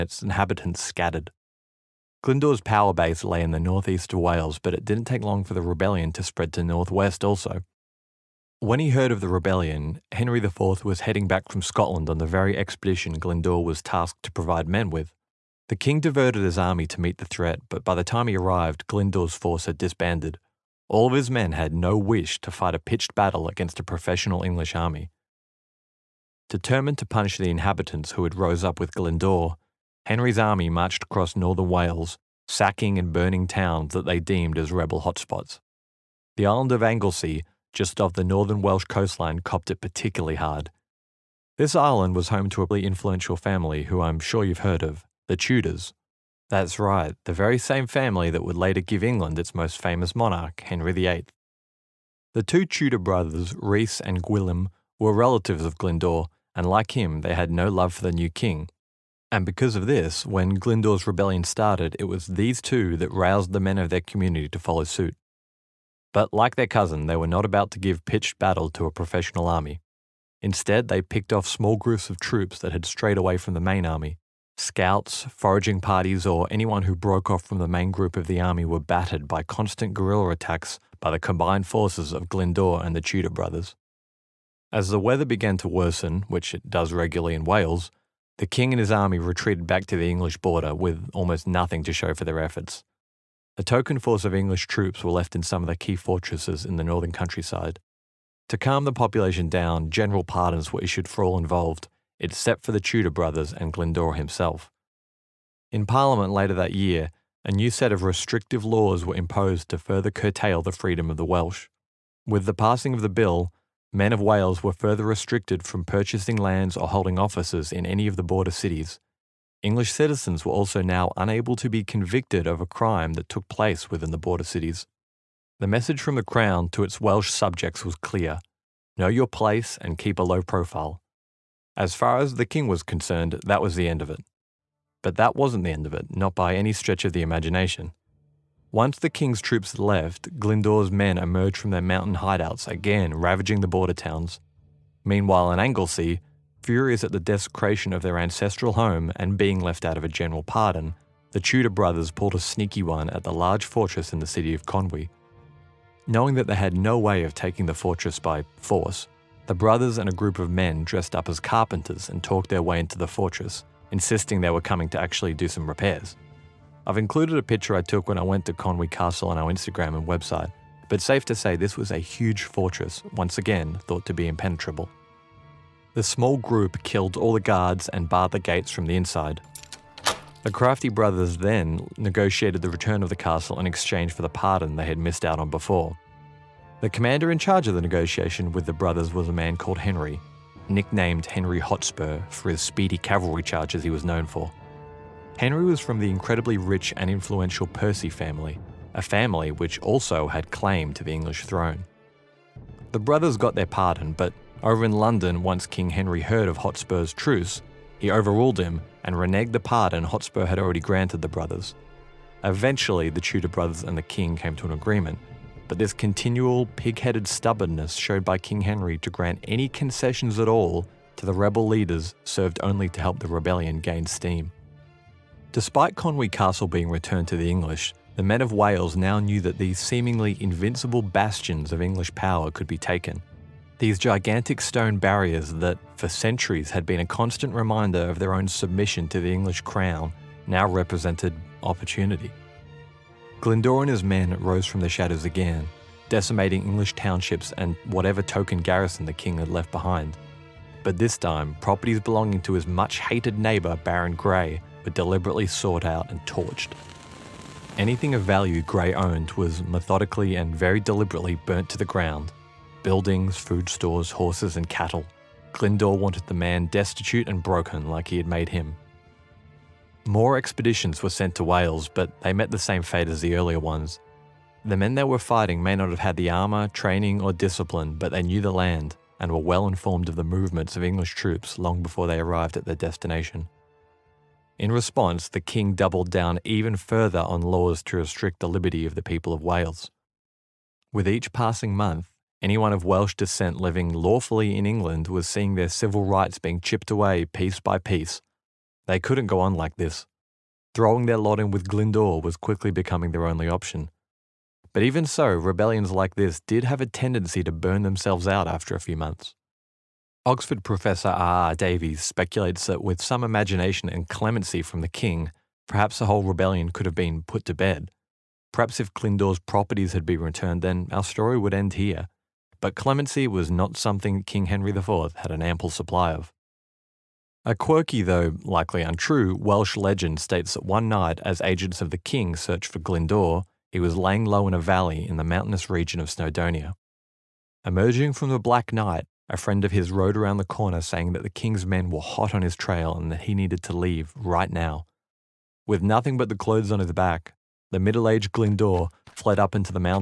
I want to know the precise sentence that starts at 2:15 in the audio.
But that wasn't the end of it, not by any stretch of the imagination.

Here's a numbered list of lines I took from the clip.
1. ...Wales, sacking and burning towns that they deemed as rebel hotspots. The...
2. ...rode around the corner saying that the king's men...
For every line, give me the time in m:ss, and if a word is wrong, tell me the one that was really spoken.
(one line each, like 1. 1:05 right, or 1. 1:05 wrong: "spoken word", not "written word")
1. 0:31 right
2. 5:39 right.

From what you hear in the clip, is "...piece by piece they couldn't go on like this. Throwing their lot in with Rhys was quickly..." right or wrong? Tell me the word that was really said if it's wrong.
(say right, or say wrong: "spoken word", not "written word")
wrong: "Glyndwr", not "Rhys".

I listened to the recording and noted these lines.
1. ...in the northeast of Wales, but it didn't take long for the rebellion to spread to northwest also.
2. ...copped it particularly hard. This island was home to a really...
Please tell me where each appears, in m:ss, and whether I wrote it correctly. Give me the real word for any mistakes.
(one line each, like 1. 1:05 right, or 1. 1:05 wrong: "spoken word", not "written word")
1. 0:03 right
2. 0:39 right.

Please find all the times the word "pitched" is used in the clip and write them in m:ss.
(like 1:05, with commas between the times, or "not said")
0:22, 1:08.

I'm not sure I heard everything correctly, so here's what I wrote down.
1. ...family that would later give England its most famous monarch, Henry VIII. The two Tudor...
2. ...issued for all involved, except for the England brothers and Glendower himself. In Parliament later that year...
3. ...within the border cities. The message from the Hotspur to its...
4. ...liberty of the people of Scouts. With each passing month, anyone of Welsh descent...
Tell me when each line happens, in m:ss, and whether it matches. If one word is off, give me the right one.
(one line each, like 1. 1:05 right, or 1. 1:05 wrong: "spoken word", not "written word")
1. 0:47 right
2. 1:40 wrong: "Tudor", not "England"
3. 2:03 wrong: "Crown", not "Hotspur"
4. 4:48 wrong: "Wales", not "Scouts".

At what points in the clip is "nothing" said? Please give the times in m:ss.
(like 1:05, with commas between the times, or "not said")
1:31, 5:45.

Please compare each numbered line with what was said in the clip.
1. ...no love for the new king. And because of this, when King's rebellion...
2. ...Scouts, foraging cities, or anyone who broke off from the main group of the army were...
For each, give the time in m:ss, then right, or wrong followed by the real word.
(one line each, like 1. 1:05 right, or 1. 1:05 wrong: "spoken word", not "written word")
1. 0:57 wrong: "Glyndwr", not "King"
2. 1:14 wrong: "parties", not "cities".